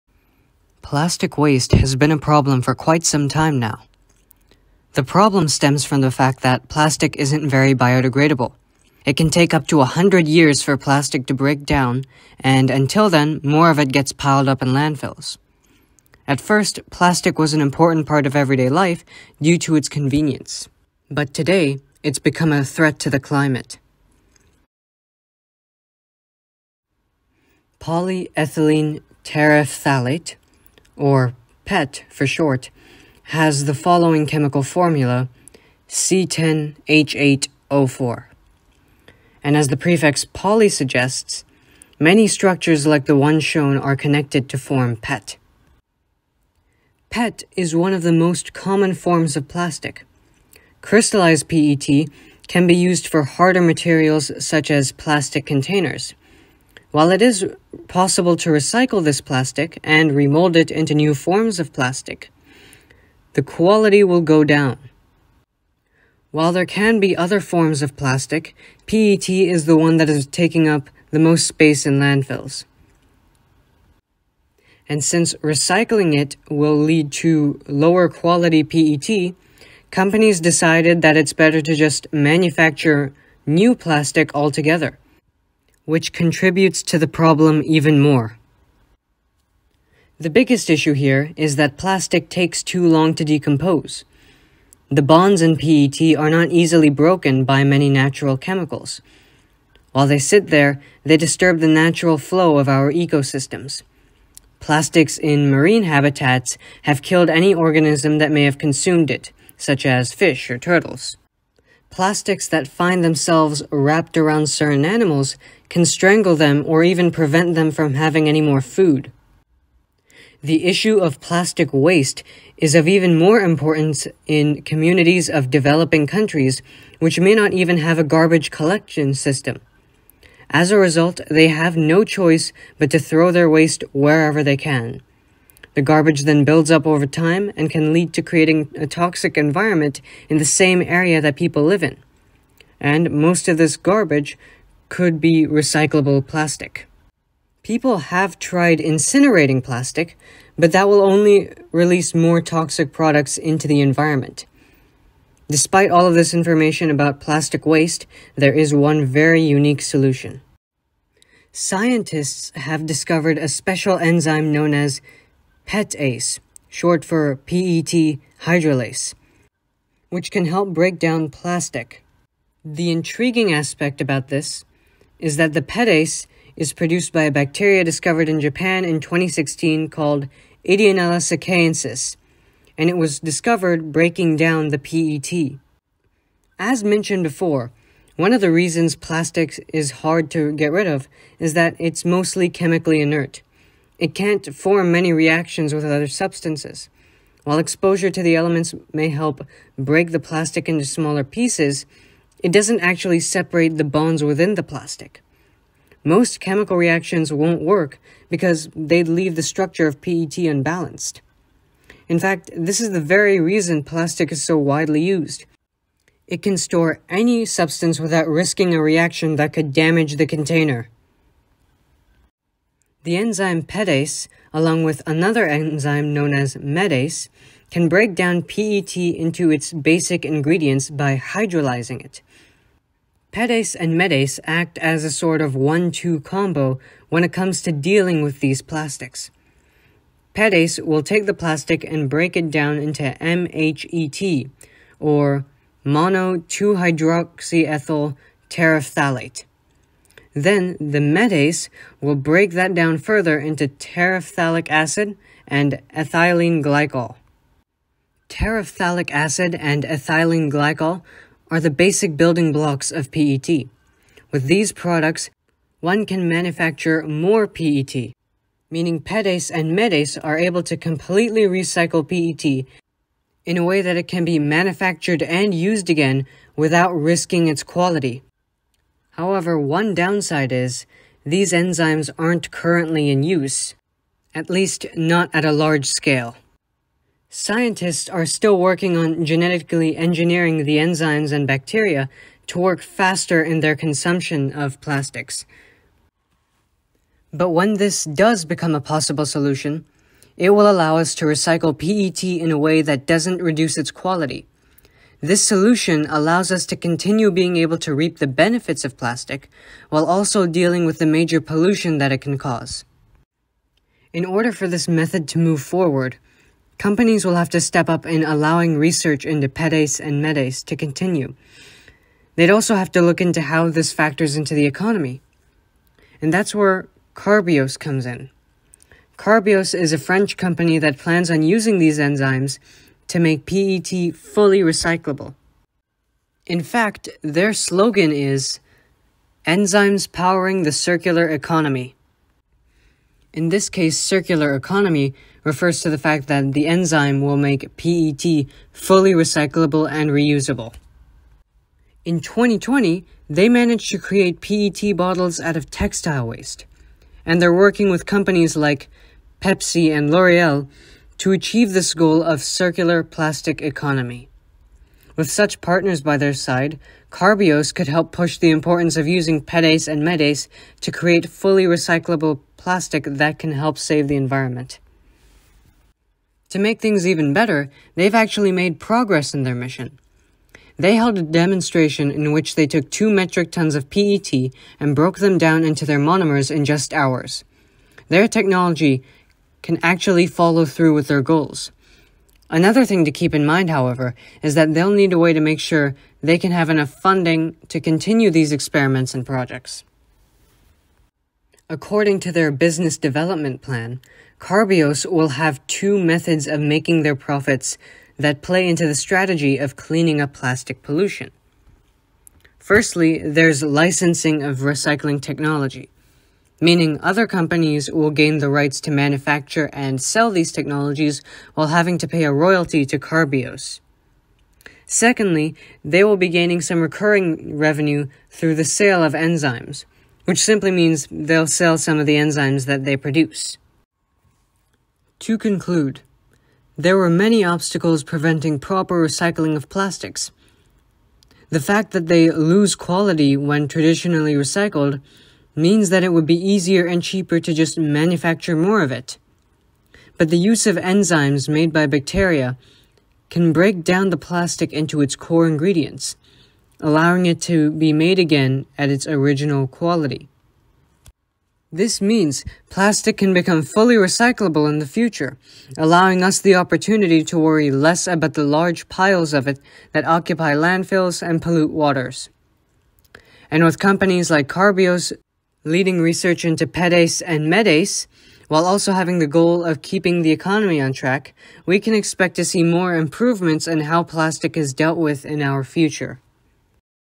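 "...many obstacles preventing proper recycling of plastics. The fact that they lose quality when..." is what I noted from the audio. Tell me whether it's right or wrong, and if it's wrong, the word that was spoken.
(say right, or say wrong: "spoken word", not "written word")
right.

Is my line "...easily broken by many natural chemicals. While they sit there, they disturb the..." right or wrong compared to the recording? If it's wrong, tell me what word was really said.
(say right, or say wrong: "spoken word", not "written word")
right.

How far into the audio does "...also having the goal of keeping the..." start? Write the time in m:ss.
7:58.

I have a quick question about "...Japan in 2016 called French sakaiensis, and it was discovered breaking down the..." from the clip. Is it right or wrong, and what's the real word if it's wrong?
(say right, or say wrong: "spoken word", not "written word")
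wrong: "Ideonella", not "French".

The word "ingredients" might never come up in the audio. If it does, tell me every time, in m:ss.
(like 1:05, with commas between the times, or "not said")
3:50, 7:35.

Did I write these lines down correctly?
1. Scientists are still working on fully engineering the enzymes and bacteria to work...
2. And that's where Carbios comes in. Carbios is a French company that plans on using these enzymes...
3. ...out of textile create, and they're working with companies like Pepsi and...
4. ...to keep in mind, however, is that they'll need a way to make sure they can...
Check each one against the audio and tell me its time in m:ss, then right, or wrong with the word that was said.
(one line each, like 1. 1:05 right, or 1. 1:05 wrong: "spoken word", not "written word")
1. 4:47 wrong: "genetically", not "fully"
2. 5:26 right
3. 5:55 wrong: "waste", not "create"
4. 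6:33 right.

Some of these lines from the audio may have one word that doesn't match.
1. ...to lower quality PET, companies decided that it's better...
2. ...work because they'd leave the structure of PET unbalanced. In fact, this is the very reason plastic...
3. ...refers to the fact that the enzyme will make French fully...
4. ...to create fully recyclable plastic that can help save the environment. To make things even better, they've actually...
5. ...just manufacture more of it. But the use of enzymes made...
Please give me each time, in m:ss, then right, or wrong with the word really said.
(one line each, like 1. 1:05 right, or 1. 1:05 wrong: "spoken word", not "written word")
1. 1:17 right
2. 3:27 right
3. 5:45 wrong: "PET", not "French"
4. 6:10 right
5. 7:27 right.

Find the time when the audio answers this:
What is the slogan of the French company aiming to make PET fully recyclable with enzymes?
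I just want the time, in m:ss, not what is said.
5:39.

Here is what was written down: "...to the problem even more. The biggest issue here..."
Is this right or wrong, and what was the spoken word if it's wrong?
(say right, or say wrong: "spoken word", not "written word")
right.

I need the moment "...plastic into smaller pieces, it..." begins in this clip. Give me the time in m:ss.
3:20.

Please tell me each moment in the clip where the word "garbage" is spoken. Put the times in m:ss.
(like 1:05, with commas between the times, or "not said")
2:08, 2:15, 2:23.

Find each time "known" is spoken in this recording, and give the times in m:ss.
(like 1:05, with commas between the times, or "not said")
2:44, 3:46.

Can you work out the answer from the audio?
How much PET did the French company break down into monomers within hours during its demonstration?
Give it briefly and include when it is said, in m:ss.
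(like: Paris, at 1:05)
2 metric tons, at 6:22.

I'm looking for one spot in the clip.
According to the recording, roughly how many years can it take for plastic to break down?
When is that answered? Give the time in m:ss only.
0:09.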